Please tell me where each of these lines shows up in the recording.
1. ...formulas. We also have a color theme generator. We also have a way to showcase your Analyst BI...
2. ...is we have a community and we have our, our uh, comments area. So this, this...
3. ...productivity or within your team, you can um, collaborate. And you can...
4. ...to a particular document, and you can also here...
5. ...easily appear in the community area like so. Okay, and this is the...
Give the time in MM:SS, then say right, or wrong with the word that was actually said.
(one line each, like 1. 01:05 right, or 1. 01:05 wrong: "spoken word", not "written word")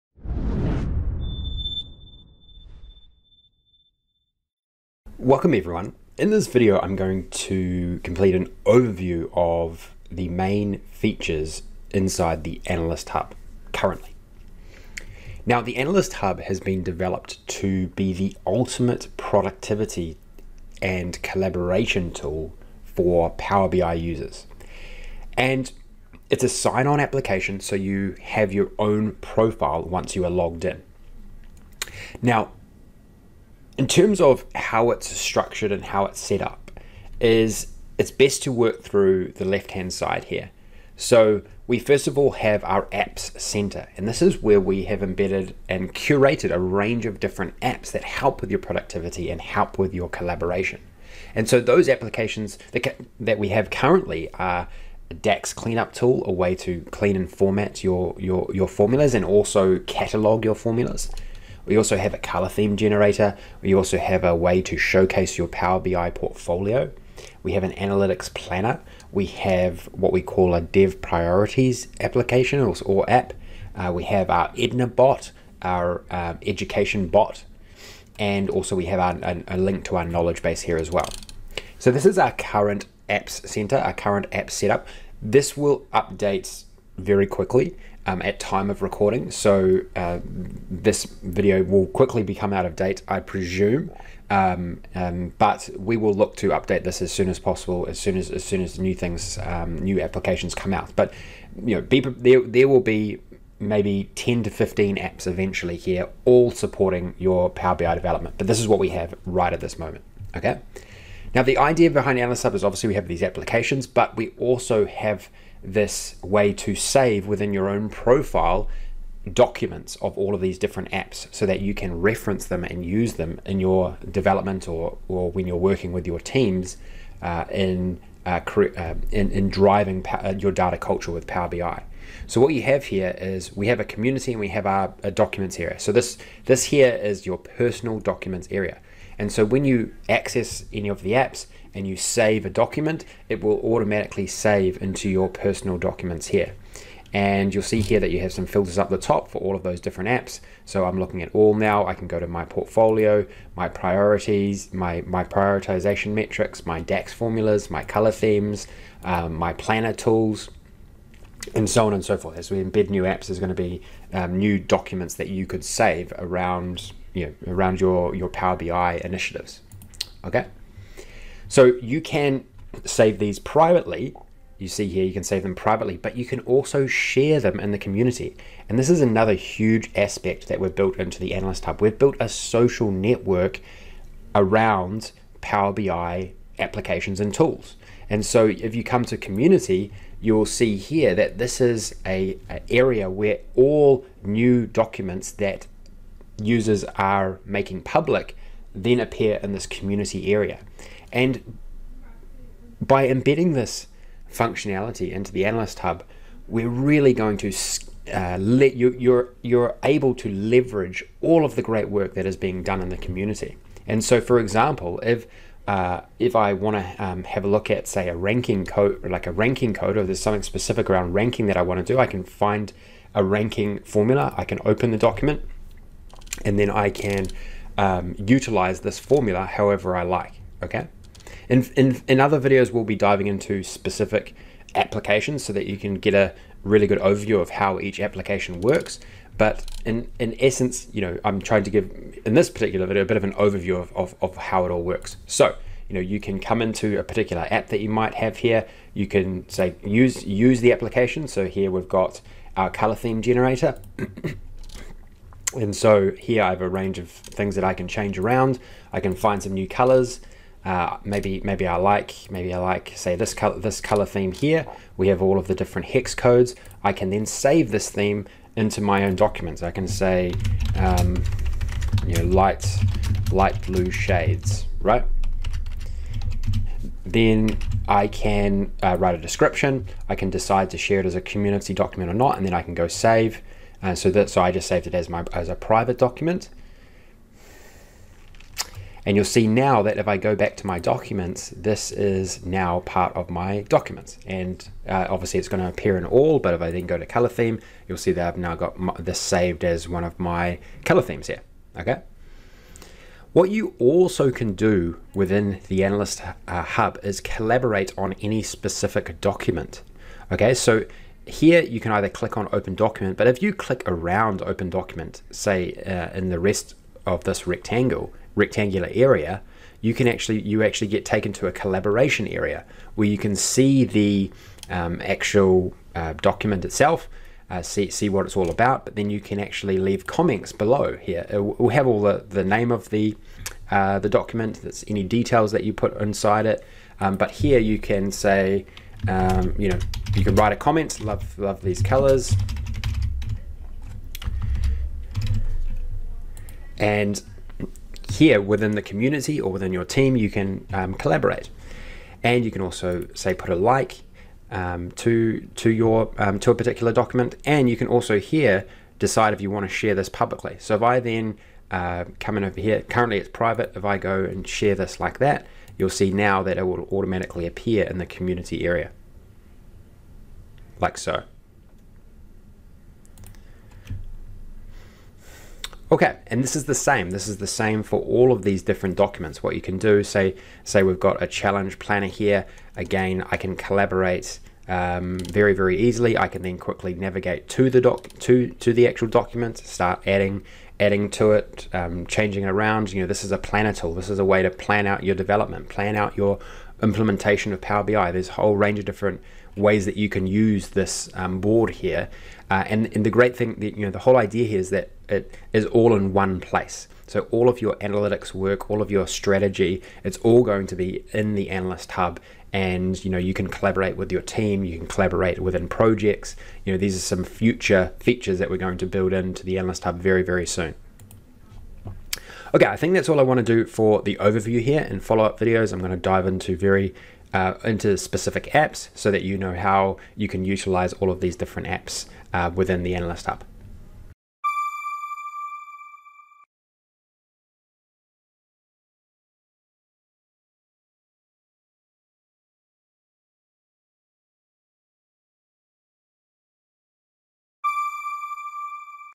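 1. 01:00 wrong: "Power", not "Analyst"
2. 02:13 wrong: "documents", not "comments"
3. 05:48 wrong: "community", not "productivity"
4. 05:56 right
5. 06:06 wrong: "automatically", not "easily".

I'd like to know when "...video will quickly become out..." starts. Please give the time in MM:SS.
01:31.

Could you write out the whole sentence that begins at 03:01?
We've built a social network around Power BI applications and tools.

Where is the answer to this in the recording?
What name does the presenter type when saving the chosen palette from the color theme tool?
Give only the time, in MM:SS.
04:33.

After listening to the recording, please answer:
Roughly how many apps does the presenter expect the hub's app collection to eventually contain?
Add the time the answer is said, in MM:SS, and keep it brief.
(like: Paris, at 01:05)
10 to 15, at 01:44.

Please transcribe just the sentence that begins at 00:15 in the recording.
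Now the Analyst Hub has been developed to be the ultimate productivity and collaboration tool for Power BI users.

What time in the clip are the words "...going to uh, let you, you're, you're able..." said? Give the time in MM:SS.
03:27.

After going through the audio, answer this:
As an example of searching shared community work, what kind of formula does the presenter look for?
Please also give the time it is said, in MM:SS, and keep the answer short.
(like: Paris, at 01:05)
Ranking formula, at 03:43.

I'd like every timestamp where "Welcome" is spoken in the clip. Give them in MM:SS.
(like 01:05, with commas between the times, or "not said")
00:05.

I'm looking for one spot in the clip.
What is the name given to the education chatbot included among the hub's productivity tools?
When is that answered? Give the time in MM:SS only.
01:14.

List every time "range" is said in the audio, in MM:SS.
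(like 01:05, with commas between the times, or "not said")
00:46, 04:16, 06:38.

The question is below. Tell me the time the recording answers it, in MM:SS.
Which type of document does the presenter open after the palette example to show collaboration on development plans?
06:21.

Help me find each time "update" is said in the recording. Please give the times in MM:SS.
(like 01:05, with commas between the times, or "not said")
01:25, 01:36.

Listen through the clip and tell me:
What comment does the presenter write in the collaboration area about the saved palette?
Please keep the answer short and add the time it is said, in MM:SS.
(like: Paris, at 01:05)
Love these colors, at 05:41.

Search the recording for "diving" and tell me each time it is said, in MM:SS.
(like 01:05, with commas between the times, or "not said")
03:52.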